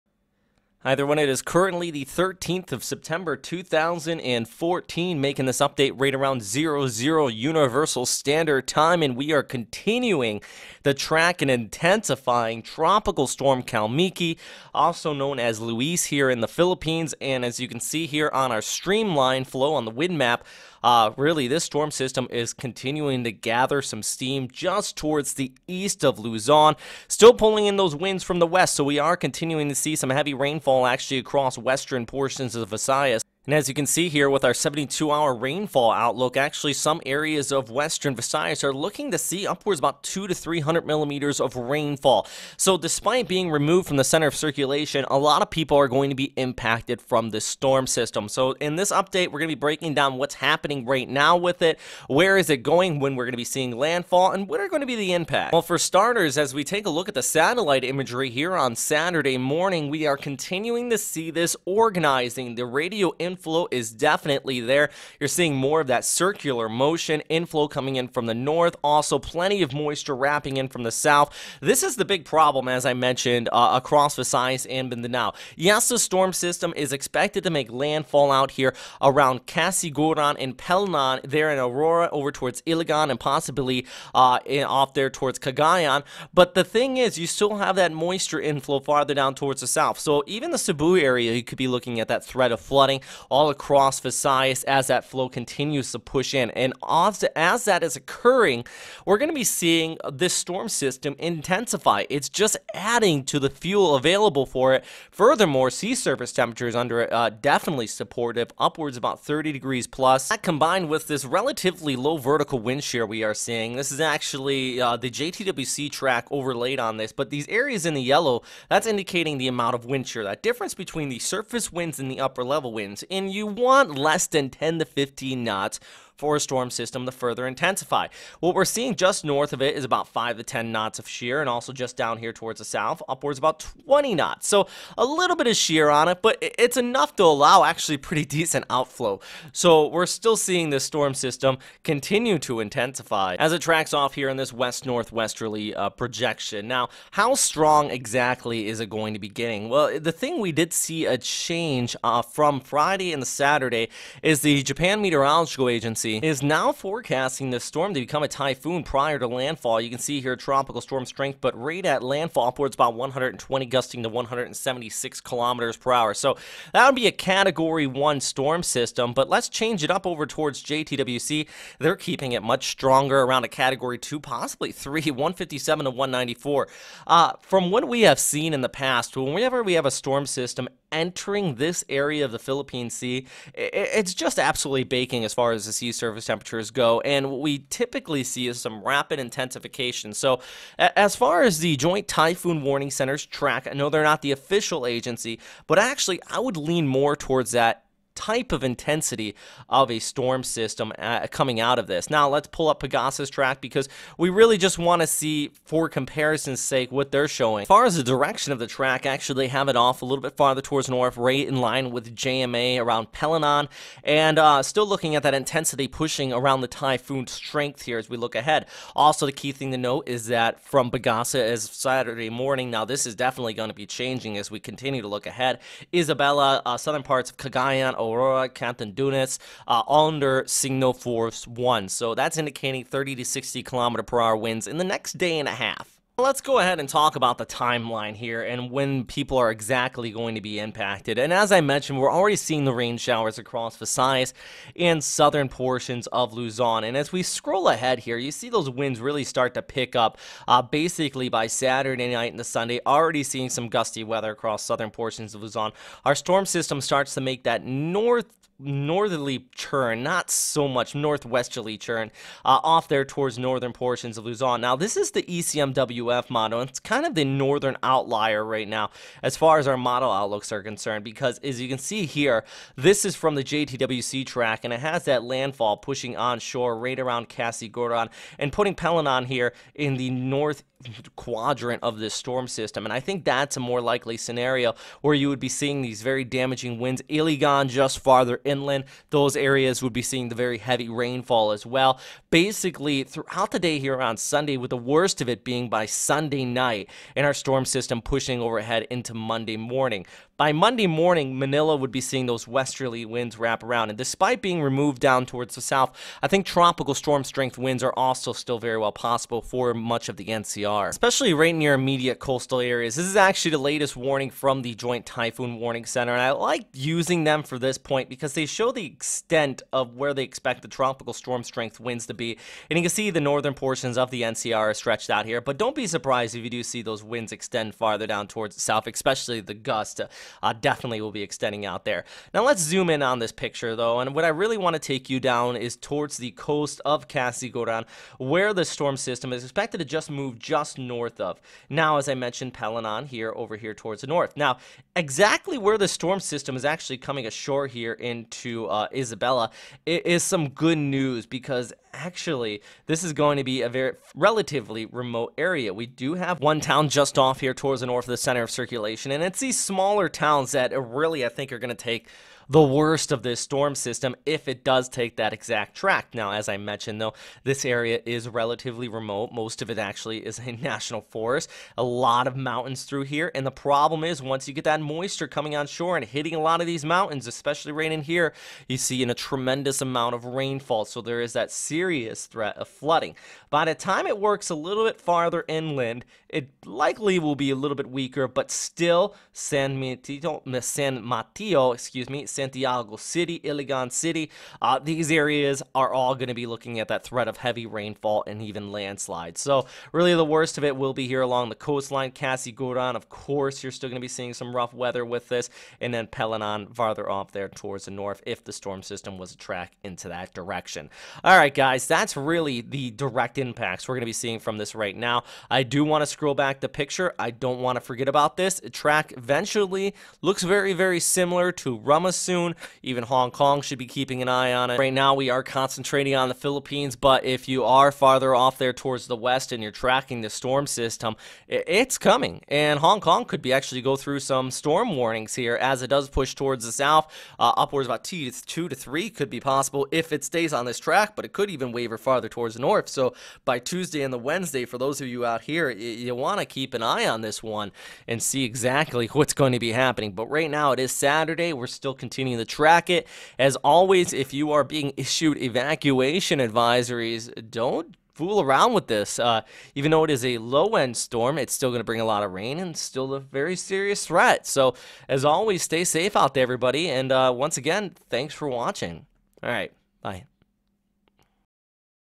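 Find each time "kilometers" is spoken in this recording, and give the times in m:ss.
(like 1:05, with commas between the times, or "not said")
2:45, 3:53.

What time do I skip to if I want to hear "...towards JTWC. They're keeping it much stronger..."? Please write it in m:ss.
2:50.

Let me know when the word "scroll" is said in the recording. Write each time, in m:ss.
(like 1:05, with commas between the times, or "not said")
4:07, 6:56.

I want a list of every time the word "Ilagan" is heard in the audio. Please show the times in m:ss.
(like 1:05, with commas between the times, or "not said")
1:22, 4:47, 6:33.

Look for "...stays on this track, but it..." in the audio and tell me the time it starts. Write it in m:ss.
7:20.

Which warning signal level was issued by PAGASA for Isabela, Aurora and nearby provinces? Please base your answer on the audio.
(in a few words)
Signal 1.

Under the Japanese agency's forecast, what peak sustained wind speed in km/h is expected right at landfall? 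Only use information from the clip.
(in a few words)
120.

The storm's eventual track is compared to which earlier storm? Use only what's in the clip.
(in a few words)
Rammasun.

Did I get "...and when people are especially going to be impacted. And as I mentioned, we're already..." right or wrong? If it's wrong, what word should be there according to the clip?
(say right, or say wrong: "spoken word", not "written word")
wrong: "exactly", not "especially".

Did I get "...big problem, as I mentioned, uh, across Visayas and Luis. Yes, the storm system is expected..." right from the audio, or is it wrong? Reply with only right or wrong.
wrong.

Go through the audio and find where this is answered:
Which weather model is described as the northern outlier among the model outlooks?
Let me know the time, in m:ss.
4:25.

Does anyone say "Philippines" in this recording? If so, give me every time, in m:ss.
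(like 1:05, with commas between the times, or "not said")
0:16, 3:02, 7:06.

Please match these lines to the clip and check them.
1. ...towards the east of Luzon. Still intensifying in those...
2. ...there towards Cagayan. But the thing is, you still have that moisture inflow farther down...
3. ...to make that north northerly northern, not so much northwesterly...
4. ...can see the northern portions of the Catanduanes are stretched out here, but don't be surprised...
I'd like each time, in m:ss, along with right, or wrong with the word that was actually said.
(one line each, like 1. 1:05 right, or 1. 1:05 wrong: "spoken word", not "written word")
1. 0:24 wrong: "pulling", not "intensifying"
2. 1:24 right
3. 4:17 wrong: "churn", not "northern"
4. 5:22 wrong: "NCR", not "Catanduanes".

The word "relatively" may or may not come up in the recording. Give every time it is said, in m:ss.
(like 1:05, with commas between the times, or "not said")
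1:51, 5:54, 6:08.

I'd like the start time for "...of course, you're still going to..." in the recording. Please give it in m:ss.
6:42.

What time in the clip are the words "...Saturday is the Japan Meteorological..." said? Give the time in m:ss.
2:33.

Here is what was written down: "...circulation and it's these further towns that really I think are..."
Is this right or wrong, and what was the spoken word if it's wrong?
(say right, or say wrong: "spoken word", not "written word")
wrong: "smaller", not "further".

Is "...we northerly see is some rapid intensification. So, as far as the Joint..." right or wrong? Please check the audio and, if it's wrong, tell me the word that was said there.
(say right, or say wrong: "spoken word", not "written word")
wrong: "typically", not "northerly".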